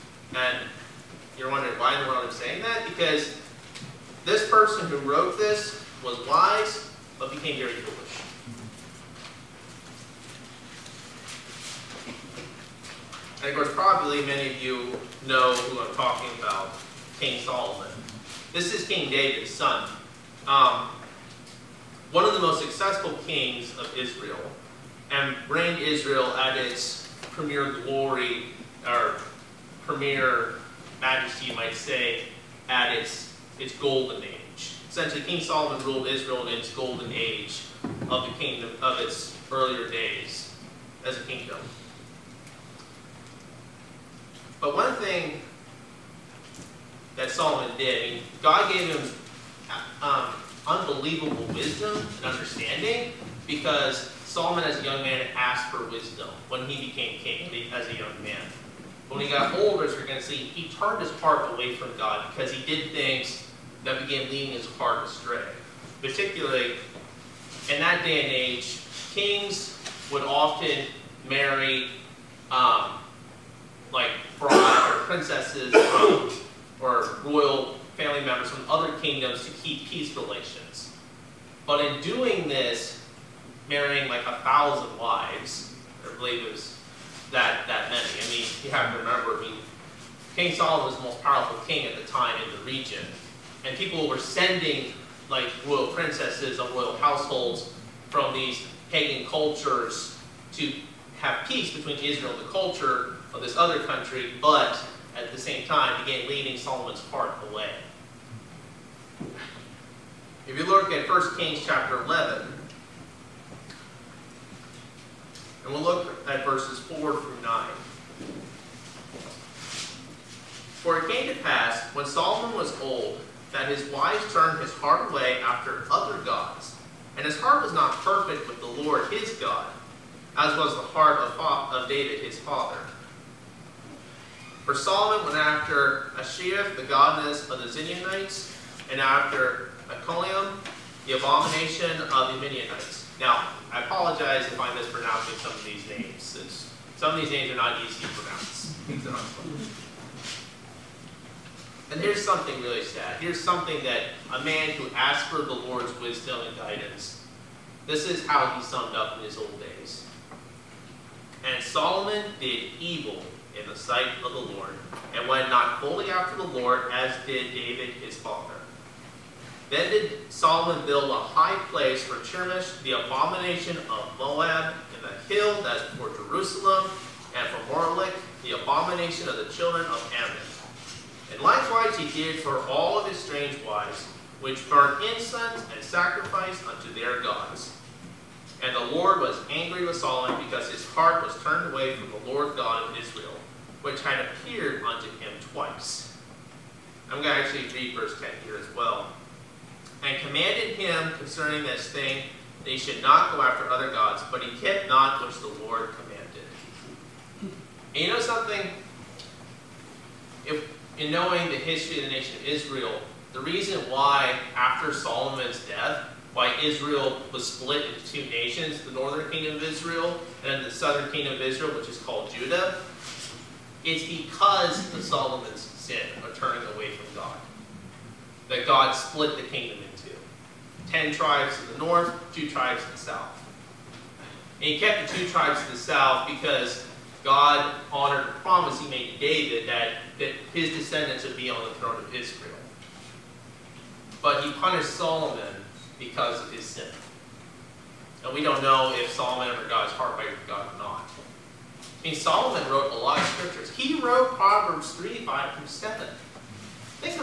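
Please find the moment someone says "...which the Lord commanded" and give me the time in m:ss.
3:25.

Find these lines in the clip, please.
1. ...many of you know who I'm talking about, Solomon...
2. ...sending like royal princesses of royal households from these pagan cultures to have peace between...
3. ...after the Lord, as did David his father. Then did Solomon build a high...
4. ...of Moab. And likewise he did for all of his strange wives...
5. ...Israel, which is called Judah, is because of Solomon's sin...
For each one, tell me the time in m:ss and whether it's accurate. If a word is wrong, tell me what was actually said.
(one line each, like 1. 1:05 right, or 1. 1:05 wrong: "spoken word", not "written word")
1. 0:14 wrong: "King", not "Solomon"
2. 1:34 right
3. 2:46 right
4. 2:59 wrong: "Ammon", not "Moab"
5. 3:41 right.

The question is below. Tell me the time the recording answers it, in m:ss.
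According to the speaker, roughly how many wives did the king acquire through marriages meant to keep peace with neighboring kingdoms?
1:24.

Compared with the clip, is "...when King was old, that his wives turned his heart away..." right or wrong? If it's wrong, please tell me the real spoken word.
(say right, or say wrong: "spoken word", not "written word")
wrong: "Solomon", not "King".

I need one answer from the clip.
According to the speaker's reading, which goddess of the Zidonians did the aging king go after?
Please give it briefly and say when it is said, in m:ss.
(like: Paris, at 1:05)
Ashiath, at 2:16.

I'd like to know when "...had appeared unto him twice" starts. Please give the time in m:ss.
3:14.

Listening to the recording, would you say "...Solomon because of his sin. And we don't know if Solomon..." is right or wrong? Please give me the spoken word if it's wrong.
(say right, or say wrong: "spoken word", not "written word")
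right.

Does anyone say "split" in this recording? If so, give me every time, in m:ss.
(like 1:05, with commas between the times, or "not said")
3:37, 3:48.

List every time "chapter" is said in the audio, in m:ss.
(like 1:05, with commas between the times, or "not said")
1:51.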